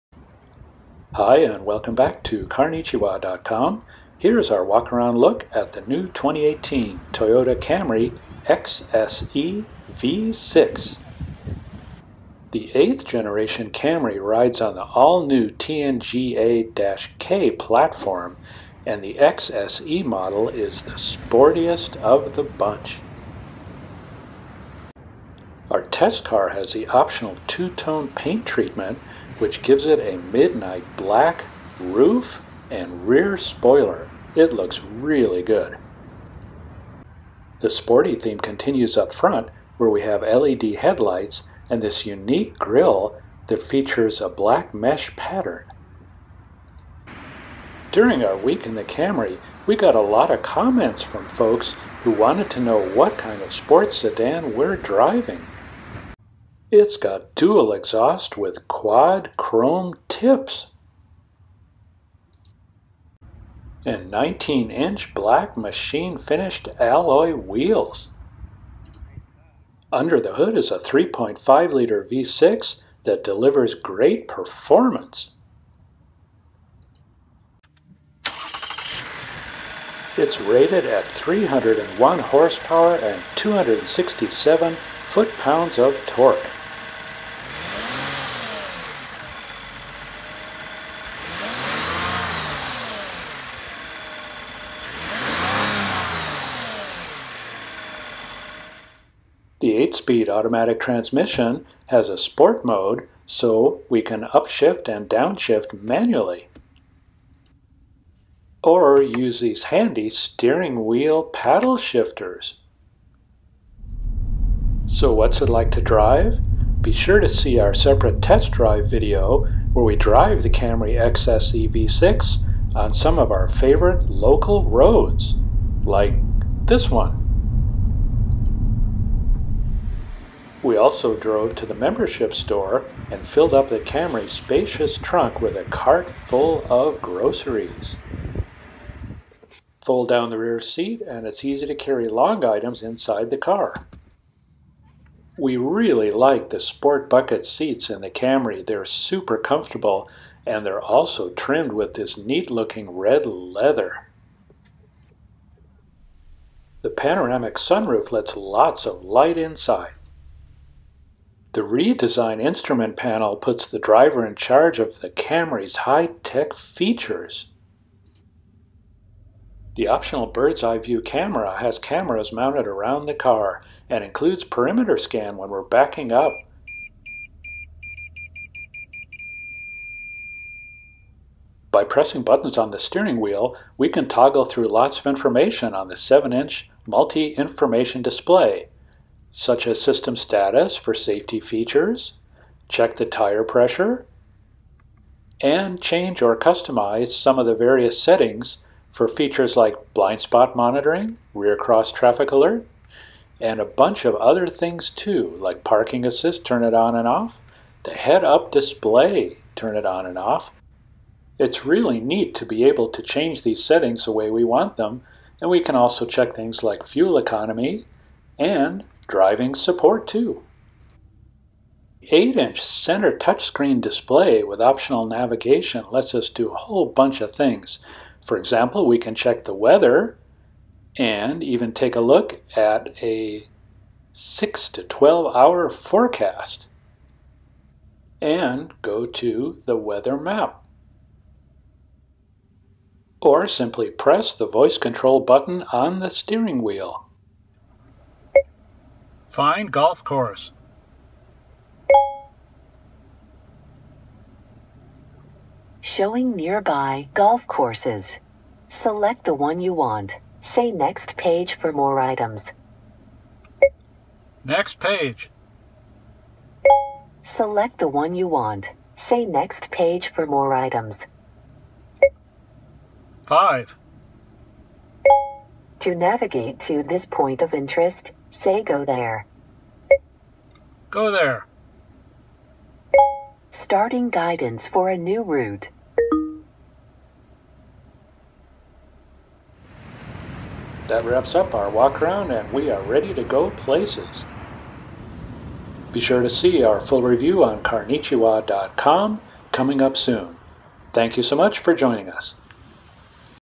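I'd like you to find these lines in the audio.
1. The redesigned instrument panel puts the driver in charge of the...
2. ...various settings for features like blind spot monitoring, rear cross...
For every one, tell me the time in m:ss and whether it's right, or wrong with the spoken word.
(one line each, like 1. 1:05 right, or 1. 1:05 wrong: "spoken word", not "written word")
1. 2:41 right
2. 3:17 right.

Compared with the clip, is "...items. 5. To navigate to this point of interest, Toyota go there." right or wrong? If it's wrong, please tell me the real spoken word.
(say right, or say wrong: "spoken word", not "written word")
wrong: "Say", not "Toyota".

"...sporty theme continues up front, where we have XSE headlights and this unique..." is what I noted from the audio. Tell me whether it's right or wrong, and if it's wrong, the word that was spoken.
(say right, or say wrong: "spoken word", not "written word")
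wrong: "LED", not "XSE".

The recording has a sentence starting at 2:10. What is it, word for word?
We also drove to the membership store and filled up the Camry's spacious trunk with a cart full of groceries.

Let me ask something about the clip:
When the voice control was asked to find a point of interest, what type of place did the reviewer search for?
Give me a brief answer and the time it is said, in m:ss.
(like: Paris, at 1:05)
Golf course, at 4:09.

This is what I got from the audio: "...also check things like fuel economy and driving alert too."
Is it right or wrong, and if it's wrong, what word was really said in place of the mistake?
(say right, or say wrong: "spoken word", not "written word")
wrong: "support", not "alert".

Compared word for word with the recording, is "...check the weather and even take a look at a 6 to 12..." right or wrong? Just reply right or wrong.
right.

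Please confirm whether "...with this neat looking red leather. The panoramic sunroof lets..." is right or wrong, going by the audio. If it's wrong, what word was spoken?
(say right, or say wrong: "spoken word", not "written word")
right.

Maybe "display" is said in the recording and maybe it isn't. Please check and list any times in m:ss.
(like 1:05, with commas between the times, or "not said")
3:08, 3:28, 3:43.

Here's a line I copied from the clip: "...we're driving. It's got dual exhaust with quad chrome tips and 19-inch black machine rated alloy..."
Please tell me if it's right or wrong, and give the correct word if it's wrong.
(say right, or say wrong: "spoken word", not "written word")
wrong: "finished", not "rated".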